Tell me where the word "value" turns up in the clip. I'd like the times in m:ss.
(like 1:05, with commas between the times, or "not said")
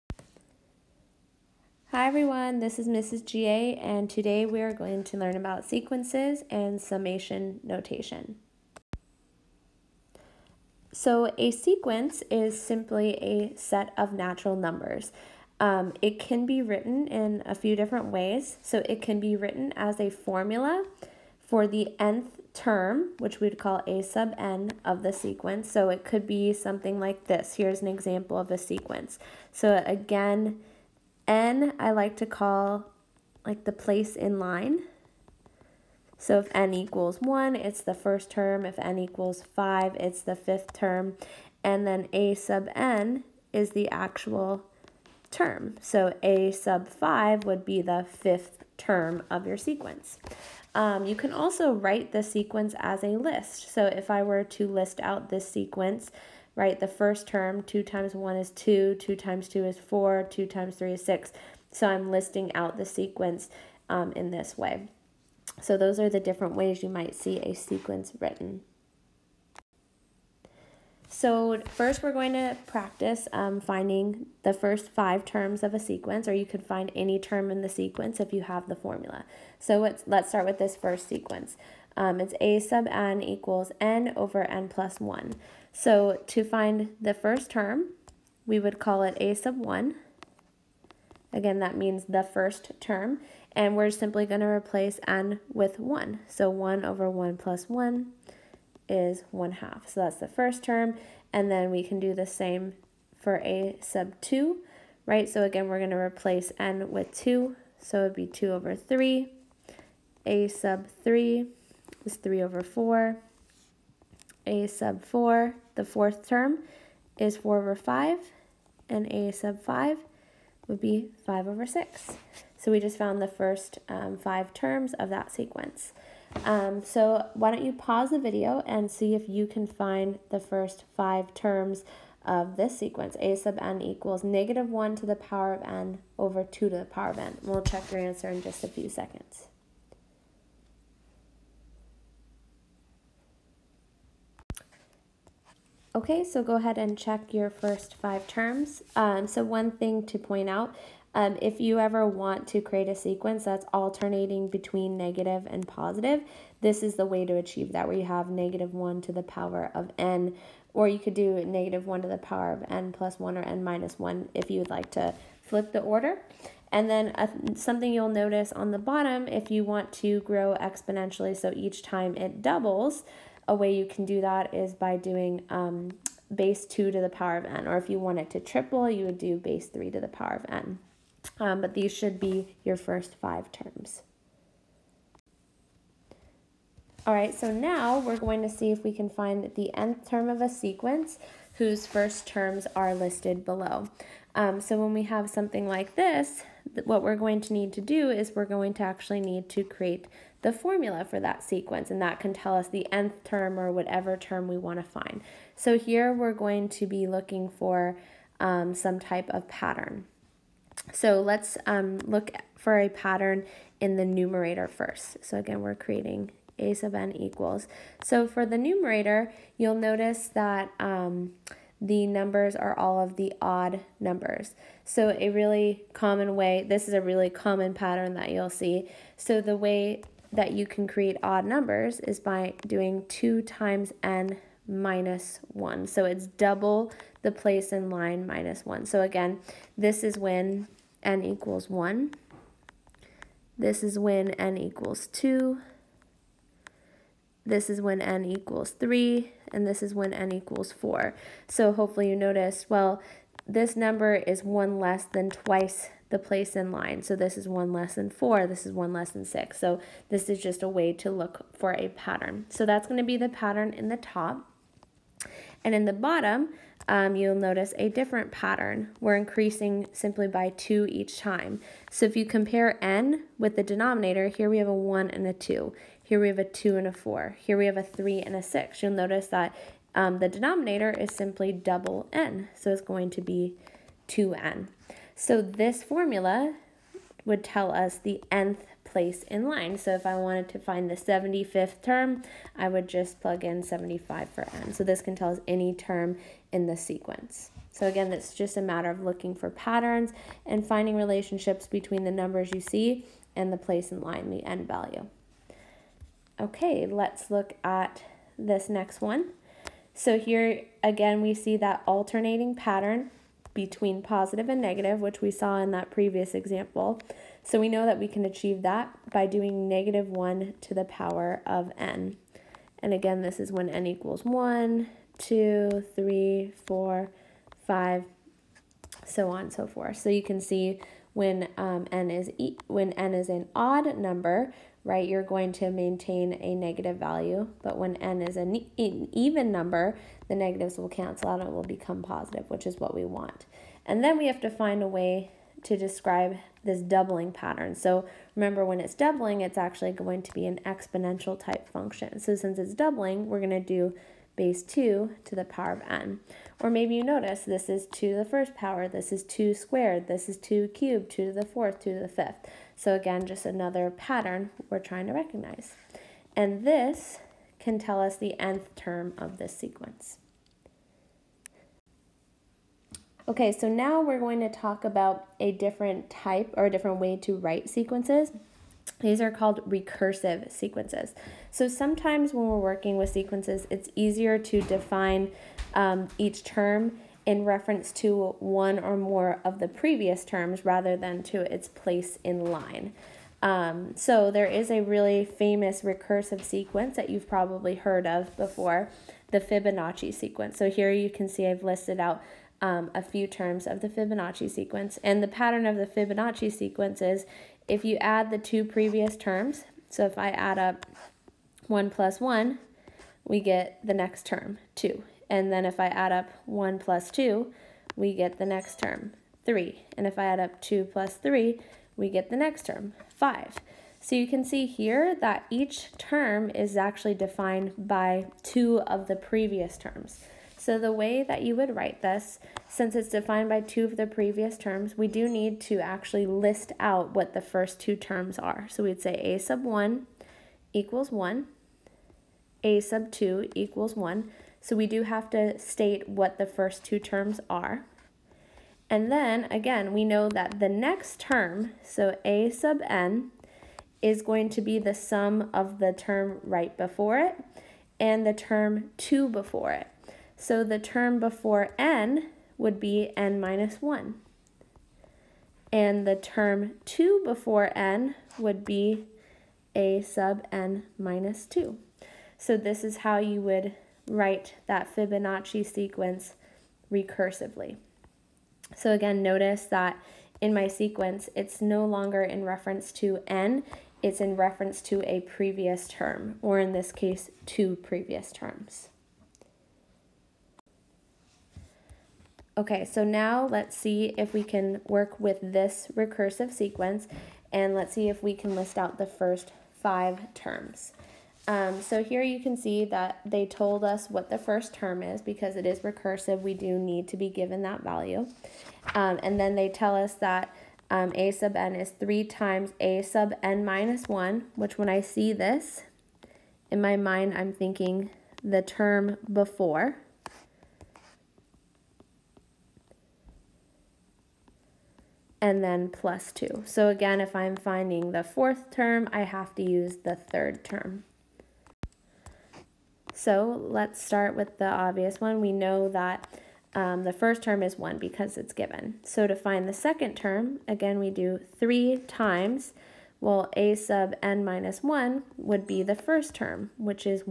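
5:04, 5:36, 8:27.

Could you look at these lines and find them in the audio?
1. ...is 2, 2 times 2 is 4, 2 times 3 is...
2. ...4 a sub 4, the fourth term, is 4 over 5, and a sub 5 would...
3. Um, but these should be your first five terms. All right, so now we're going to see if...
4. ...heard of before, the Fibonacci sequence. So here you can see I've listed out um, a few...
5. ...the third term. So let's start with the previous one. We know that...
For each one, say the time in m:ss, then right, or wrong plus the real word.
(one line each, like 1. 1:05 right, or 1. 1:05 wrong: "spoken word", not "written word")
1. 0:58 right
2. 1:52 right
3. 3:01 right
4. 6:37 right
5. 8:50 wrong: "obvious", not "previous".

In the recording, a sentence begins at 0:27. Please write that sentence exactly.
Here's an example of a sequence.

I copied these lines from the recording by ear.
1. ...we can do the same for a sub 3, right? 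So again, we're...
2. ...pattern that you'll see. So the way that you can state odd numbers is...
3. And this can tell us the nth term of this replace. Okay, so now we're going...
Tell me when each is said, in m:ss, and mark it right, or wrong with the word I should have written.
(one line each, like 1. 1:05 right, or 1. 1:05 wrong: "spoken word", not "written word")
1. 1:41 wrong: "2", not "3"
2. 3:47 wrong: "create", not "state"
3. 6:06 wrong: "sequence", not "replace".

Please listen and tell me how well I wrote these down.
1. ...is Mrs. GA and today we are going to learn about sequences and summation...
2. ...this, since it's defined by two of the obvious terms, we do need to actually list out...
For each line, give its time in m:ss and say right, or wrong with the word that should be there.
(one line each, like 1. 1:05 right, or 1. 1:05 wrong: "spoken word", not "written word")
1. 0:02 right
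2. 7:12 wrong: "previous", not "obvious".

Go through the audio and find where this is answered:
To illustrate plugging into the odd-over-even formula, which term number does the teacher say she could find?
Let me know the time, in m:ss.
4:50.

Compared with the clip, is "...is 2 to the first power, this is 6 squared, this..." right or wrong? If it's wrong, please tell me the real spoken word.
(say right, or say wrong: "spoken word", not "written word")
wrong: "2", not "6".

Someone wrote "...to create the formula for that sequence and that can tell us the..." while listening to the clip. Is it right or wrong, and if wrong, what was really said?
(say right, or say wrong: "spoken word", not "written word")
right.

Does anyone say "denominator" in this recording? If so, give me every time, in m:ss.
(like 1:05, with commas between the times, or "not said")
4:33, 4:40.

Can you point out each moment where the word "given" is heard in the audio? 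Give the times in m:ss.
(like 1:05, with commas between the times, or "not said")
8:27, 8:58.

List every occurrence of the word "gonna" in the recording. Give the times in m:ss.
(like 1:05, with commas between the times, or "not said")
4:22.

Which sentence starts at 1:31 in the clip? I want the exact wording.
Again, that means the first term.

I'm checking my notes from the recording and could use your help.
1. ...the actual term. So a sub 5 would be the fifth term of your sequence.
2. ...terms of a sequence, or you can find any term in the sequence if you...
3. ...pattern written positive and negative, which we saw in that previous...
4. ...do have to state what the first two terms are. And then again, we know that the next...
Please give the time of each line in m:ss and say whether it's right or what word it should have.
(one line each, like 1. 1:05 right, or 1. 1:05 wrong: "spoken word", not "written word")
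1. 0:43 right
2. 1:15 right
3. 5:12 wrong: "between", not "written"
4. 7:24 right.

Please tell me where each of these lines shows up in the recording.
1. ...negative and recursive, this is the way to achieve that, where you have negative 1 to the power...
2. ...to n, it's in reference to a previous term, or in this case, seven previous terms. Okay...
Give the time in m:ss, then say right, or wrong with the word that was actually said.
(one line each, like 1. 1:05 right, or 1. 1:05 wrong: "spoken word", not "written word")
1. 2:34 wrong: "positive", not "recursive"
2. 8:02 wrong: "two", not "seven".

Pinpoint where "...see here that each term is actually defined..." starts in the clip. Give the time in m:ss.
7:04.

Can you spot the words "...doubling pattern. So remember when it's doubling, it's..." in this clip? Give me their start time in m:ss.
5:46.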